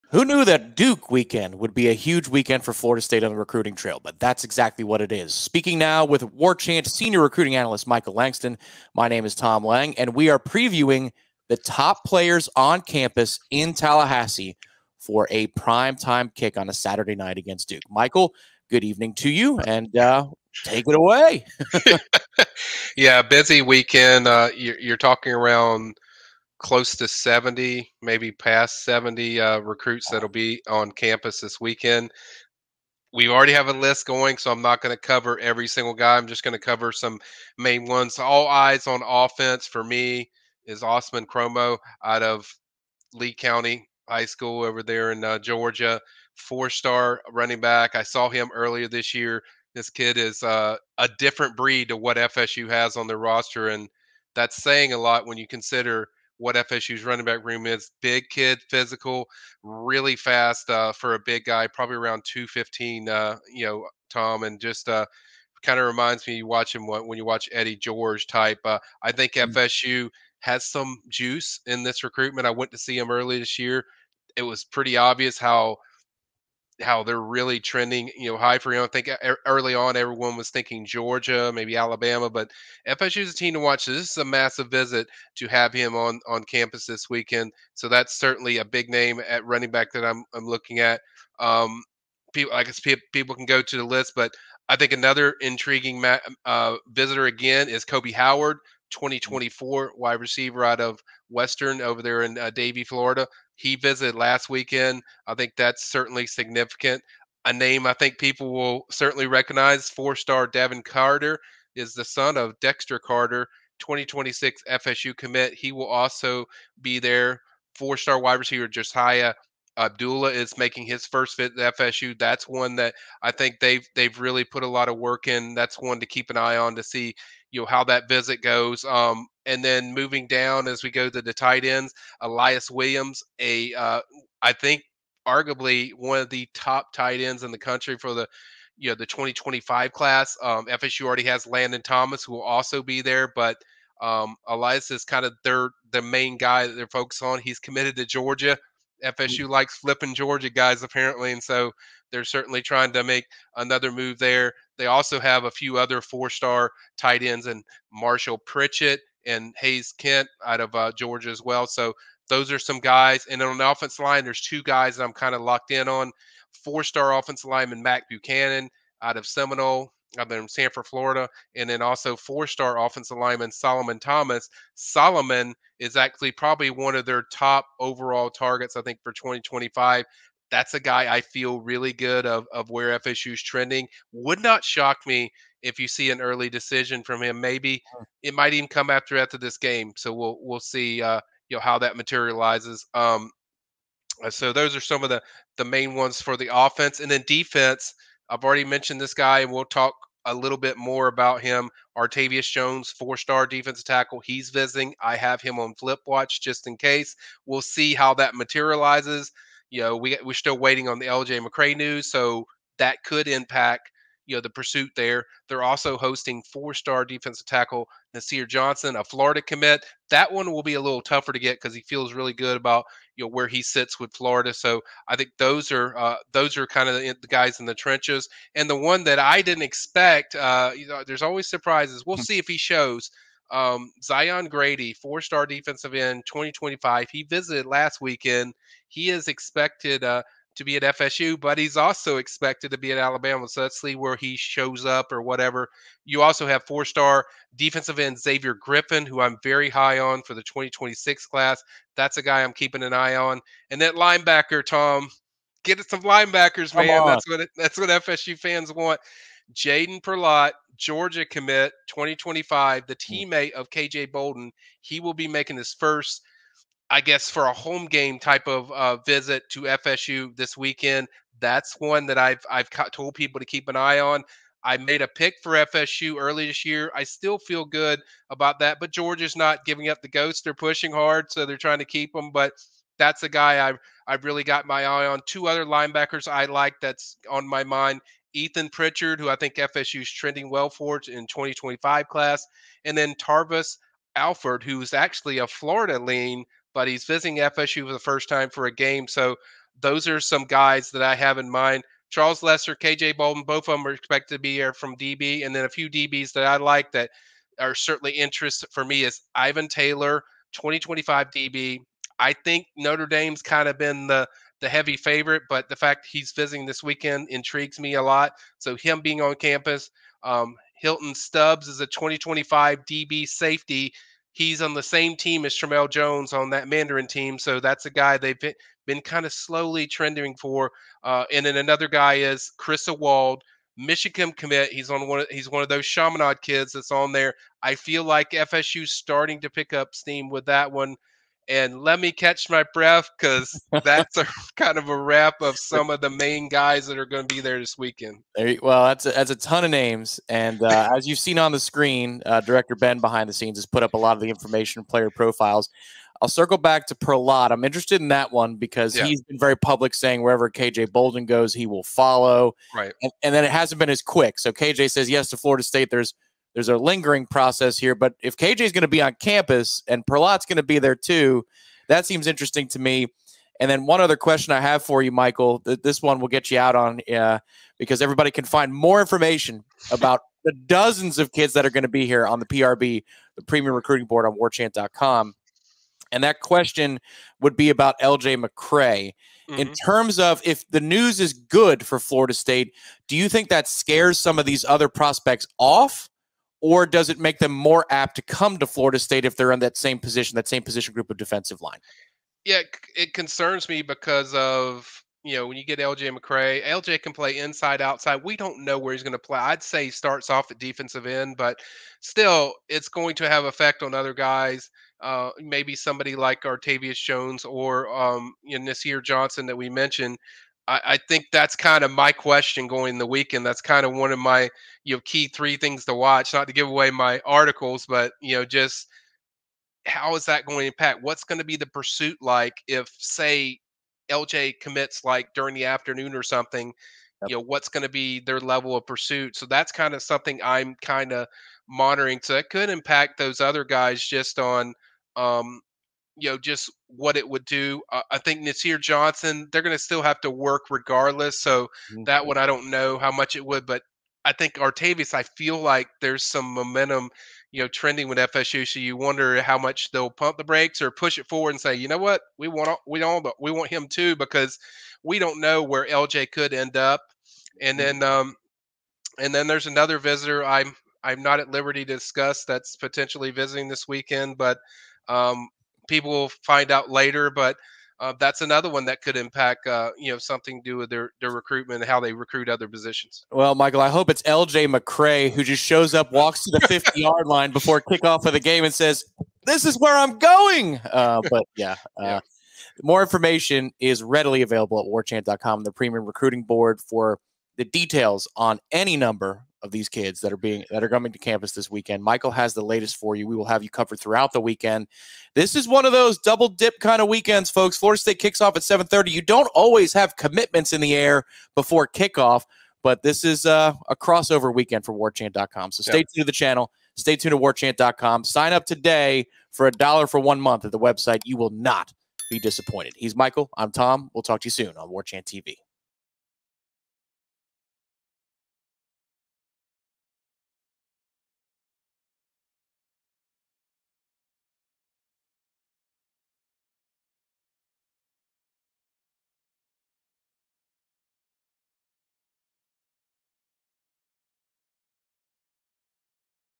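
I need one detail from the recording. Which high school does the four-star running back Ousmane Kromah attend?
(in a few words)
Lee County High School.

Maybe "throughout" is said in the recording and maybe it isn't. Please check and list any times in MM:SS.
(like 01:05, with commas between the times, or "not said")
08:23.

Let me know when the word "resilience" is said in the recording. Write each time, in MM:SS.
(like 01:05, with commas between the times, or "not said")
not said.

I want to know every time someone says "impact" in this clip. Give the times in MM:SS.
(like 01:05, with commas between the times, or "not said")
03:33, 07:10, 07:22, 07:59.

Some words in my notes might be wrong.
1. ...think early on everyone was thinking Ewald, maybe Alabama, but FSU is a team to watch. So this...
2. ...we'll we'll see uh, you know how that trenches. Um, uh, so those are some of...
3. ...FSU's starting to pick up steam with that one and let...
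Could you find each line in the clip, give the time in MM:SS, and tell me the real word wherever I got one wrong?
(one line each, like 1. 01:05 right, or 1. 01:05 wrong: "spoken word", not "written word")
1. 01:18 wrong: "Georgia", not "Ewald"
2. 03:10 wrong: "materializes", not "trenches"
3. 05:38 right.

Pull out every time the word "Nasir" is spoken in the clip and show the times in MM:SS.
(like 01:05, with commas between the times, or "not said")
03:38, 06:58, 07:28.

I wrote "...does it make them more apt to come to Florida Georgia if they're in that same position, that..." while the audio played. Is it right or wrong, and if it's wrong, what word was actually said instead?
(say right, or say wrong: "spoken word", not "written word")
wrong: "State", not "Georgia".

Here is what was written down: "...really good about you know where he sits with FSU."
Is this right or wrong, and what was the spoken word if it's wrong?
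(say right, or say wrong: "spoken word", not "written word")
wrong: "Florida", not "FSU".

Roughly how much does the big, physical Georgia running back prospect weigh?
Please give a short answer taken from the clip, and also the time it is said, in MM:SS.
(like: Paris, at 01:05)
215, at 01:02.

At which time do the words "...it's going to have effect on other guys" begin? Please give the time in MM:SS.
06:52.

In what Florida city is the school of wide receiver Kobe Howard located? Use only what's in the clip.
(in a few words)
Davie.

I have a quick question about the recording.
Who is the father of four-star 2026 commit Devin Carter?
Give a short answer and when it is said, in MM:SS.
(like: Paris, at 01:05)
Dexter Carter, at 01:52.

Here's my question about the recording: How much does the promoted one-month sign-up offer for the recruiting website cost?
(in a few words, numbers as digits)
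a dollar.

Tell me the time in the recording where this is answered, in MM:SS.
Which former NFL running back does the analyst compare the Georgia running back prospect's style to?
01:07.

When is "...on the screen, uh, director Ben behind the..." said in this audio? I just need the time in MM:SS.
05:51.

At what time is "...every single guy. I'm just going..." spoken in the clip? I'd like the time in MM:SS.
00:35.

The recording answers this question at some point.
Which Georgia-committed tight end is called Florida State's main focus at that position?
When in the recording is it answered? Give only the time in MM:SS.
02:12.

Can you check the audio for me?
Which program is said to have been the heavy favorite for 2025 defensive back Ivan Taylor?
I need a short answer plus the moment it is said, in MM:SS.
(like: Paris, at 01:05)
Notre Dame, at 05:12.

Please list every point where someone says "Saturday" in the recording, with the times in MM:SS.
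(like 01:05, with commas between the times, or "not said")
00:16.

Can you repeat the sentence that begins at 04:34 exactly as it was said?
I made a pick for FSU early this year.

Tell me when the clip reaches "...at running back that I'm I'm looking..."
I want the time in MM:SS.
01:29.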